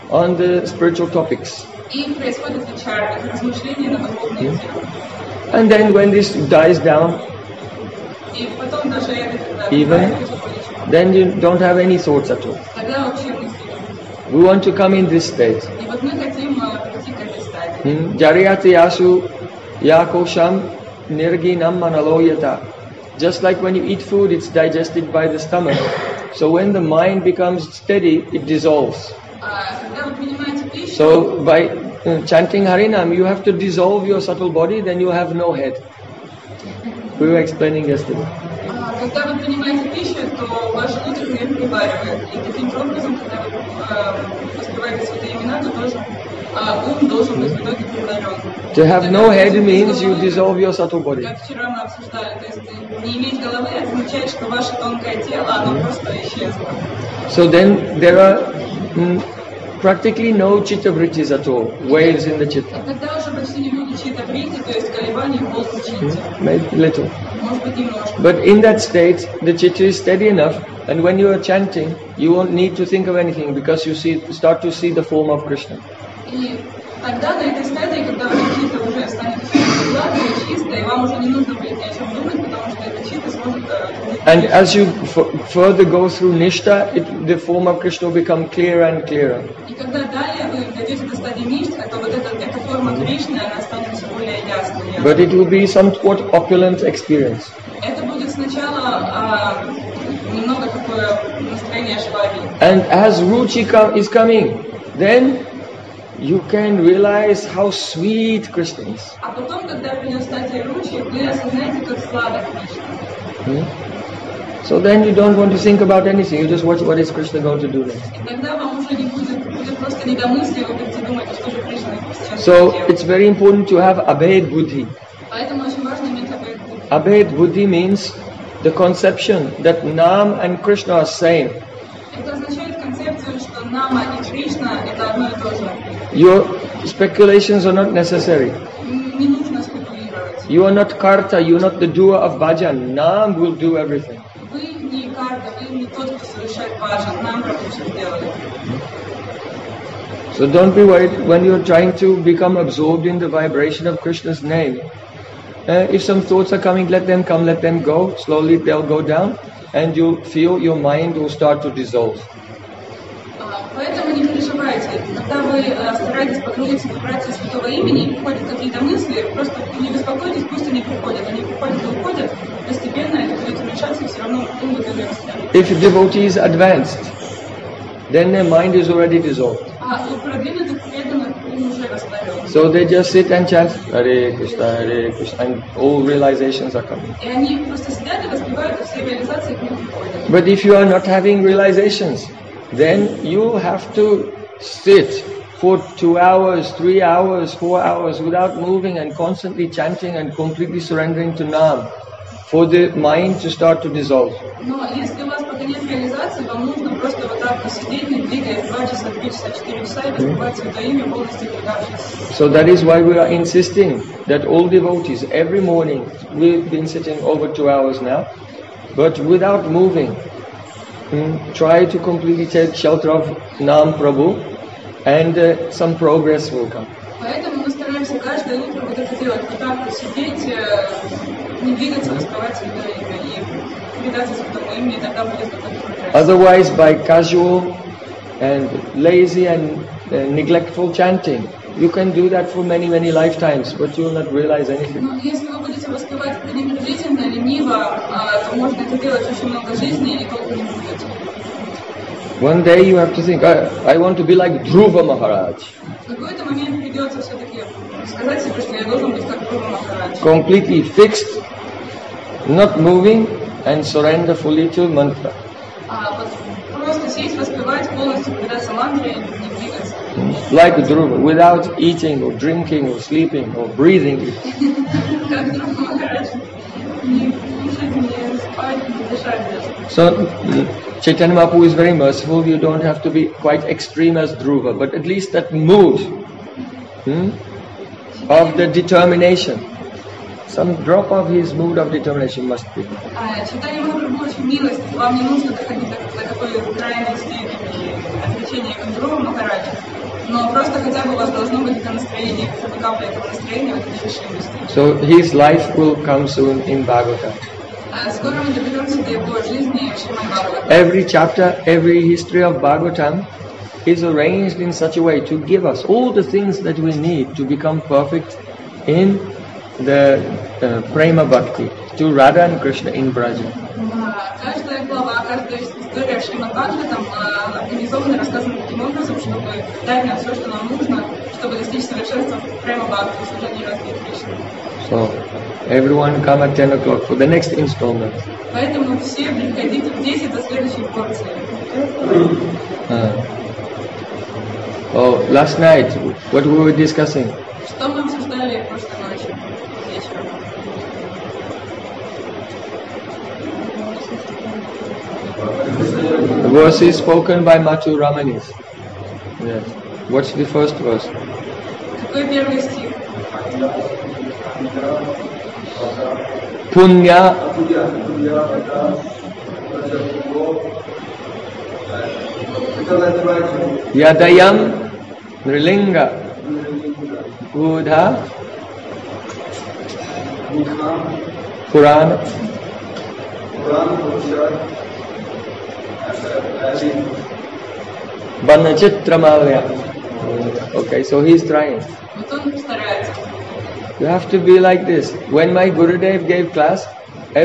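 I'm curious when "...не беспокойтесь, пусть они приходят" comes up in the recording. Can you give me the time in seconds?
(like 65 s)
169 s.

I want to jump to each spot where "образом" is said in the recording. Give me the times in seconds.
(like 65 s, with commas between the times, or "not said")
42 s, 328 s.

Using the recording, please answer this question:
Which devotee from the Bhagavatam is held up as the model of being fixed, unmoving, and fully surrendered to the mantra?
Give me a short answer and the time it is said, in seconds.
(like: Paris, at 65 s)
Dhruva Maharaj, at 254 s.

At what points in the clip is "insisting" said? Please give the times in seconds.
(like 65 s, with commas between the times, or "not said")
213 s.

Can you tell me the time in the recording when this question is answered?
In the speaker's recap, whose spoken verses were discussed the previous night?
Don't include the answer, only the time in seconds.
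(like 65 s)
357 s.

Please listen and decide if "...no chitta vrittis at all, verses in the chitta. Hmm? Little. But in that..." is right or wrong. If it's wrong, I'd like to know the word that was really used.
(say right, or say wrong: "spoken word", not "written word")
wrong: "waves", not "verses".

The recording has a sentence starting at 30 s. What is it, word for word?
So by uh, chanting Harinam, you have to dissolve your subtle body, then you have no head.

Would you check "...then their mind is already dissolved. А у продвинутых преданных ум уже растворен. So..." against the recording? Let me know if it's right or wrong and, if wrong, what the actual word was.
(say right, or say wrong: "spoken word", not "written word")
right.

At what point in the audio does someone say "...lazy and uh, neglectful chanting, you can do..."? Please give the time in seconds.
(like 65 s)
239 s.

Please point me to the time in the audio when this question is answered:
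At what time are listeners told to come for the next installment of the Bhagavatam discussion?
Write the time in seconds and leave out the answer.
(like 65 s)
336 s.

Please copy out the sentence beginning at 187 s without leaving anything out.
И они просто сидят и воспевают, и все реализации к ним приходят.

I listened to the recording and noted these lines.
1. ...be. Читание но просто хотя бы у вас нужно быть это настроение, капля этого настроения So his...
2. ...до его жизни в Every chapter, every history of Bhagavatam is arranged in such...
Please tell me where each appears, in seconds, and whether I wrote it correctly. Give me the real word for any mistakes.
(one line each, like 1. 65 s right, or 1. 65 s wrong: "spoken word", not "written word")
1. 292 s wrong: "должно", not "нужно"
2. 309 s right.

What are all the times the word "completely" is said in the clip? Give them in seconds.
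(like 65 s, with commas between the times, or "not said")
200 s, 221 s, 260 s.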